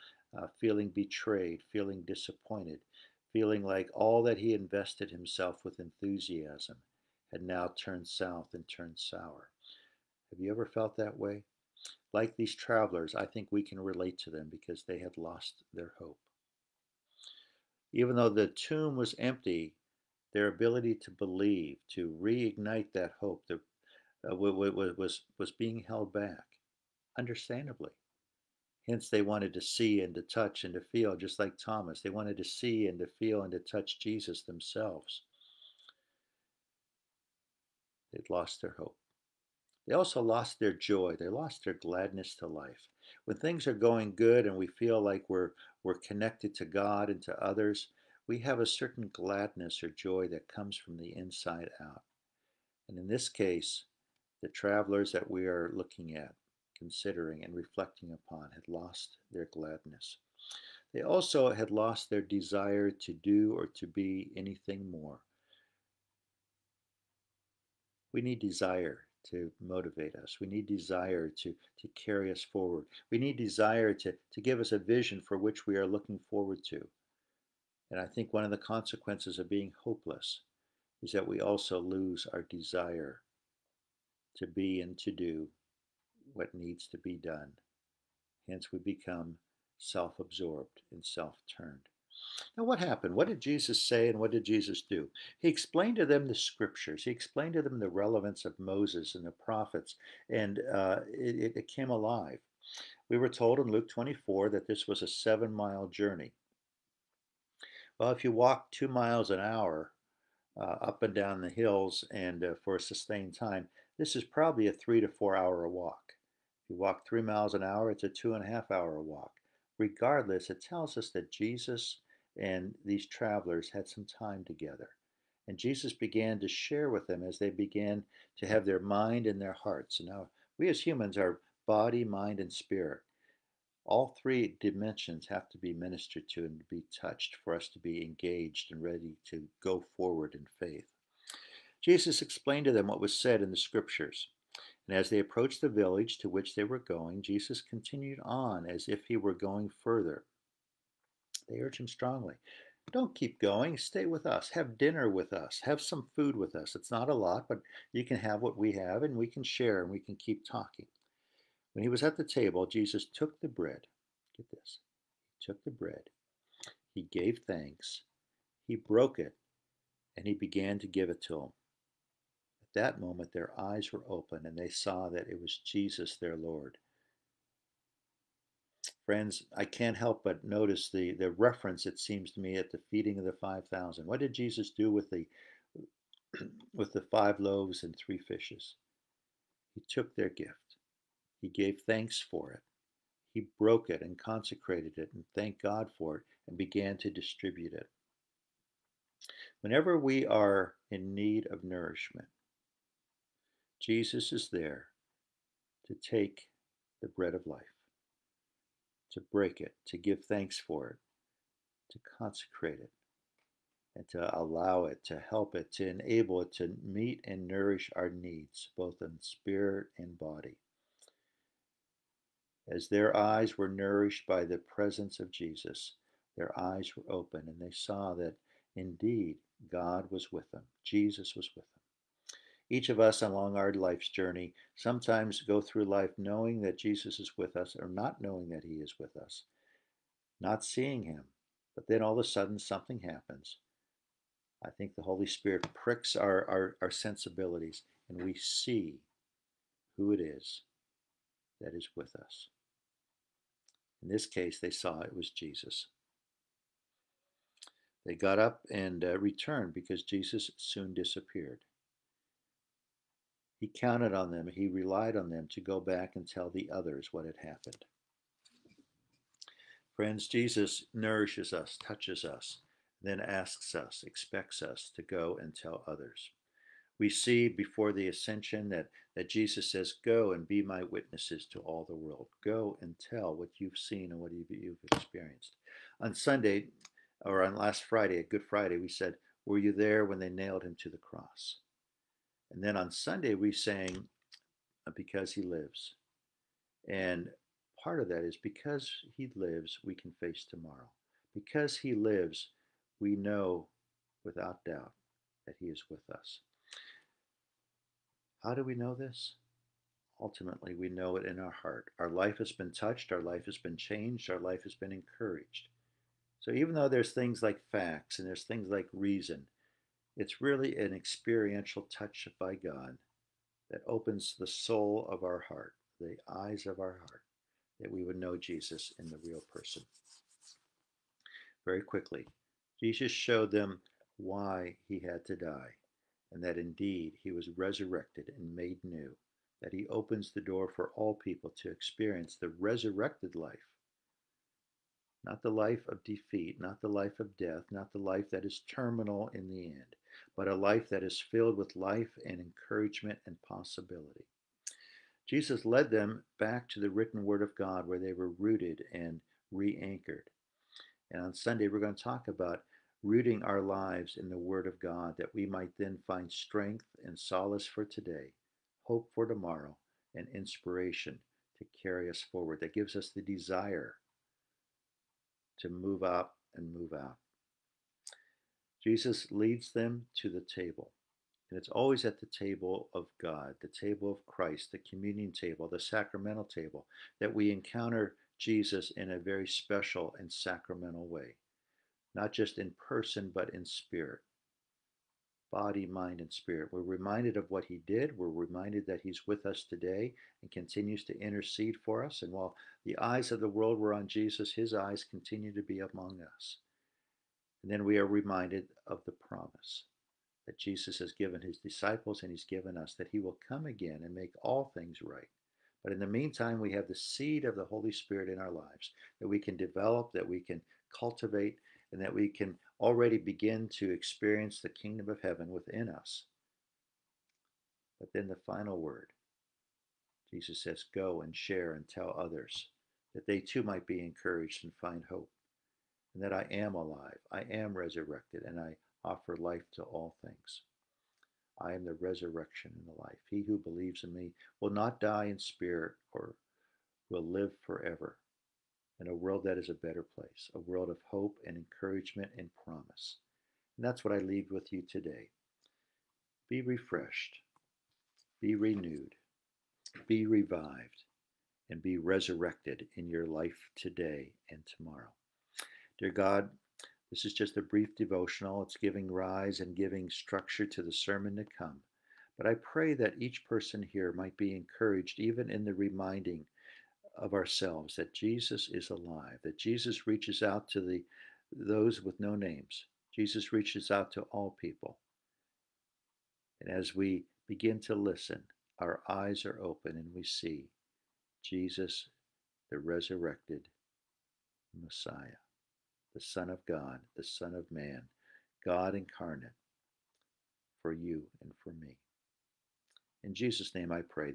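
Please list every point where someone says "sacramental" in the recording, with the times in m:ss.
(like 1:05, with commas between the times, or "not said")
6:25, 6:30.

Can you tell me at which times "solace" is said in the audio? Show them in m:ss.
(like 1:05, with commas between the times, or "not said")
6:07.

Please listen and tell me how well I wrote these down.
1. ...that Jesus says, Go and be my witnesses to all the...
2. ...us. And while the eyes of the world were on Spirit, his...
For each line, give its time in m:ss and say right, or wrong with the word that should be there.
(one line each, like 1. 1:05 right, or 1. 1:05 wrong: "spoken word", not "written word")
1. 4:39 right
2. 6:42 wrong: "Jesus", not "Spirit".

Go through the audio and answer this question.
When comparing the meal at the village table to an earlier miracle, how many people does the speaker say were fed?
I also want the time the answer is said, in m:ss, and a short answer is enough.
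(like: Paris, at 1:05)
5,000, at 3:03.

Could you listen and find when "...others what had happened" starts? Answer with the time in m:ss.
4:26.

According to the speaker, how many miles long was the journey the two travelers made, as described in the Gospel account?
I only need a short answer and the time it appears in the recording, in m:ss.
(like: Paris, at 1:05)
7, at 1:45.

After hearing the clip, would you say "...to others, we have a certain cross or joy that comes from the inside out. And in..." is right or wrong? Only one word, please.
wrong.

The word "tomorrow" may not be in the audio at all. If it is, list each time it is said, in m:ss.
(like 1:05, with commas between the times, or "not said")
5:00, 6:09, 7:44.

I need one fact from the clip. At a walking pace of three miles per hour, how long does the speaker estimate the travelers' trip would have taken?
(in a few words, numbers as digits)
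2.5 hours.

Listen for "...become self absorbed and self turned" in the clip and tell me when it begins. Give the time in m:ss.
1:28.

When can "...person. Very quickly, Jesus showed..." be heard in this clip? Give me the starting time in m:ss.
5:29.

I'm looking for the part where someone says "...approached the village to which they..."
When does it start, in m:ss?
2:25.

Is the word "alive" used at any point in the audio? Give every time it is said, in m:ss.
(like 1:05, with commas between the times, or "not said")
1:41, 7:16, 7:58.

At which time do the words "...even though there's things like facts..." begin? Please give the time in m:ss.
5:16.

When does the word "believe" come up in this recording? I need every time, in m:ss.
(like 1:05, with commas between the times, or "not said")
0:21, 7:23.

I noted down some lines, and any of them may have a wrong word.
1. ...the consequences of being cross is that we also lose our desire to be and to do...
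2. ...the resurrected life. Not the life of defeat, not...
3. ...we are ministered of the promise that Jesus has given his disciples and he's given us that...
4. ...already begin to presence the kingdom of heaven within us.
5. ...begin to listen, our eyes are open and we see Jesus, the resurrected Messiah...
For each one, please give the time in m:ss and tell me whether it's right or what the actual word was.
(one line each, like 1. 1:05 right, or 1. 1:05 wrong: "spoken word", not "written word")
1. 1:18 wrong: "hopeless", not "cross"
2. 5:42 right
3. 6:47 wrong: "reminded", not "ministered"
4. 7:02 wrong: "experience", not "presence"
5. 8:07 right.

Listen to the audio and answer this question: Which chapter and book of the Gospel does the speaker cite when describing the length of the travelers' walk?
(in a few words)
Luke 24.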